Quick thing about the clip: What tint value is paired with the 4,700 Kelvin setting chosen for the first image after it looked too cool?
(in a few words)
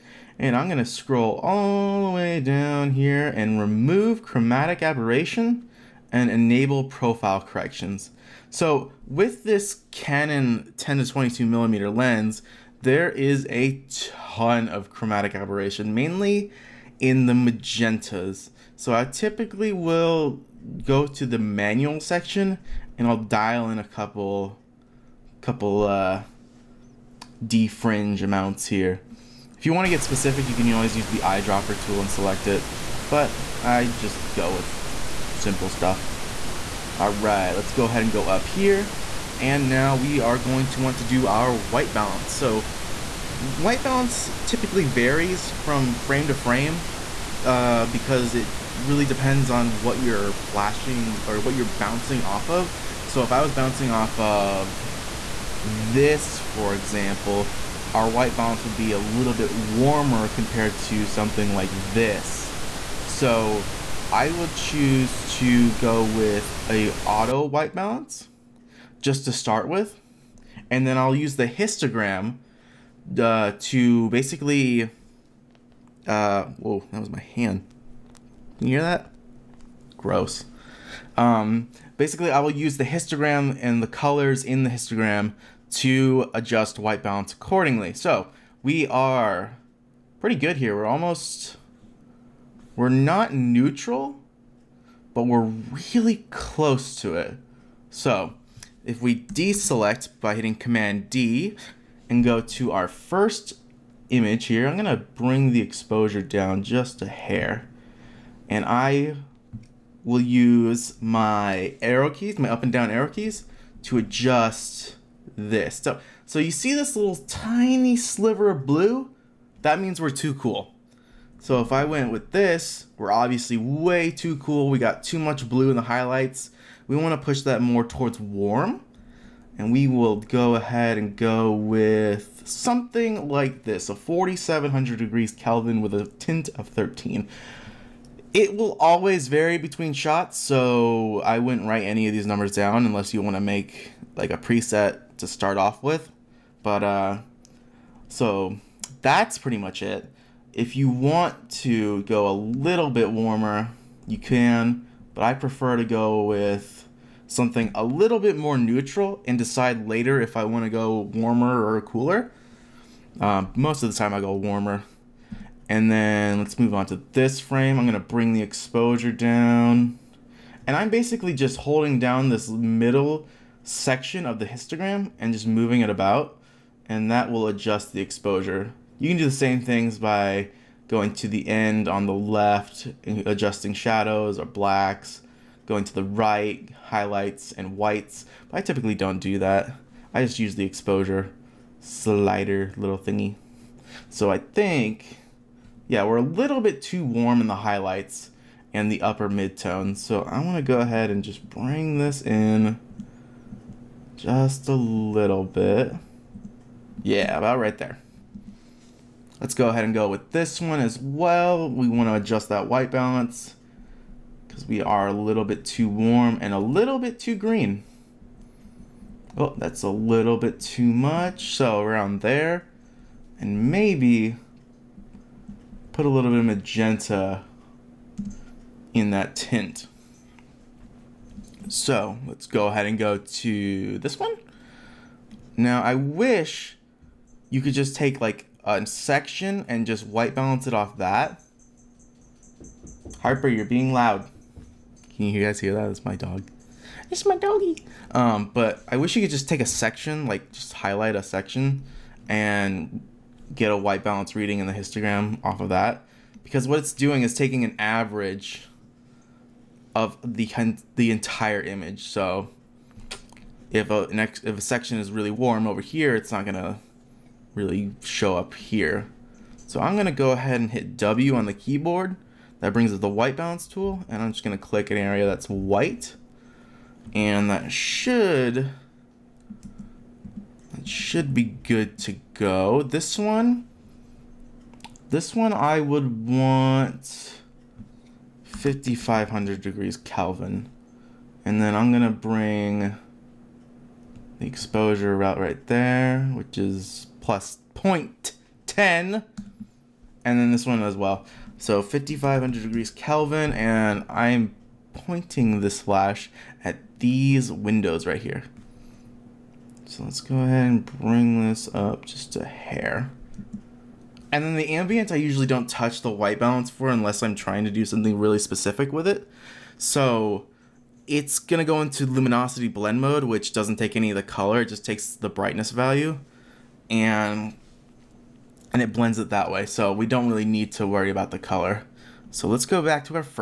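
13.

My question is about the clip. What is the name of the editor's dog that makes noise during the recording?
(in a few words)
Harper.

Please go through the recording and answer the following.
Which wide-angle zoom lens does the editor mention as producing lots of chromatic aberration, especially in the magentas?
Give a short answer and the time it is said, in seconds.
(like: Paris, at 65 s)
Canon 10-22mm, at 9 s.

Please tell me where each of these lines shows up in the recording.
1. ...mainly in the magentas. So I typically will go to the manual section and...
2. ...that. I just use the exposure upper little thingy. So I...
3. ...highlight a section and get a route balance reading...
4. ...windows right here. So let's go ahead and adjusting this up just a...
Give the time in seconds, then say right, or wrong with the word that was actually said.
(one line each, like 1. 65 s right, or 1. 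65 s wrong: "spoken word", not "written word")
1. 15 s right
2. 189 s wrong: "slider", not "upper"
3. 250 s wrong: "white", not "route"
4. 307 s wrong: "bring", not "adjusting".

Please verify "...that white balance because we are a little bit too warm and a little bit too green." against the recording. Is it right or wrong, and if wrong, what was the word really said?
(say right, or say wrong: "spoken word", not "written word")
right.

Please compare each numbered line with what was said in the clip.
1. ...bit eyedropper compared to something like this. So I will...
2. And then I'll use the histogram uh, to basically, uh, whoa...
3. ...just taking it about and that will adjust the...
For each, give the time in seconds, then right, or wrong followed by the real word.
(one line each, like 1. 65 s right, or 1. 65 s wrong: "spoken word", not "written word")
1. 59 s wrong: "warmer", not "eyedropper"
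2. 70 s right
3. 175 s wrong: "moving", not "taking".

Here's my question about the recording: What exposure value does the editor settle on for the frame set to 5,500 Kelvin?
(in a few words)
+0.10.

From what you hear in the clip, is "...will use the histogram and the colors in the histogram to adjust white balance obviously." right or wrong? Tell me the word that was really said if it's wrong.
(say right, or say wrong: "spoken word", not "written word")
wrong: "accordingly", not "obviously".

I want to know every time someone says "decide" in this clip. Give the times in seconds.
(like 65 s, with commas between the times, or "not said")
159 s.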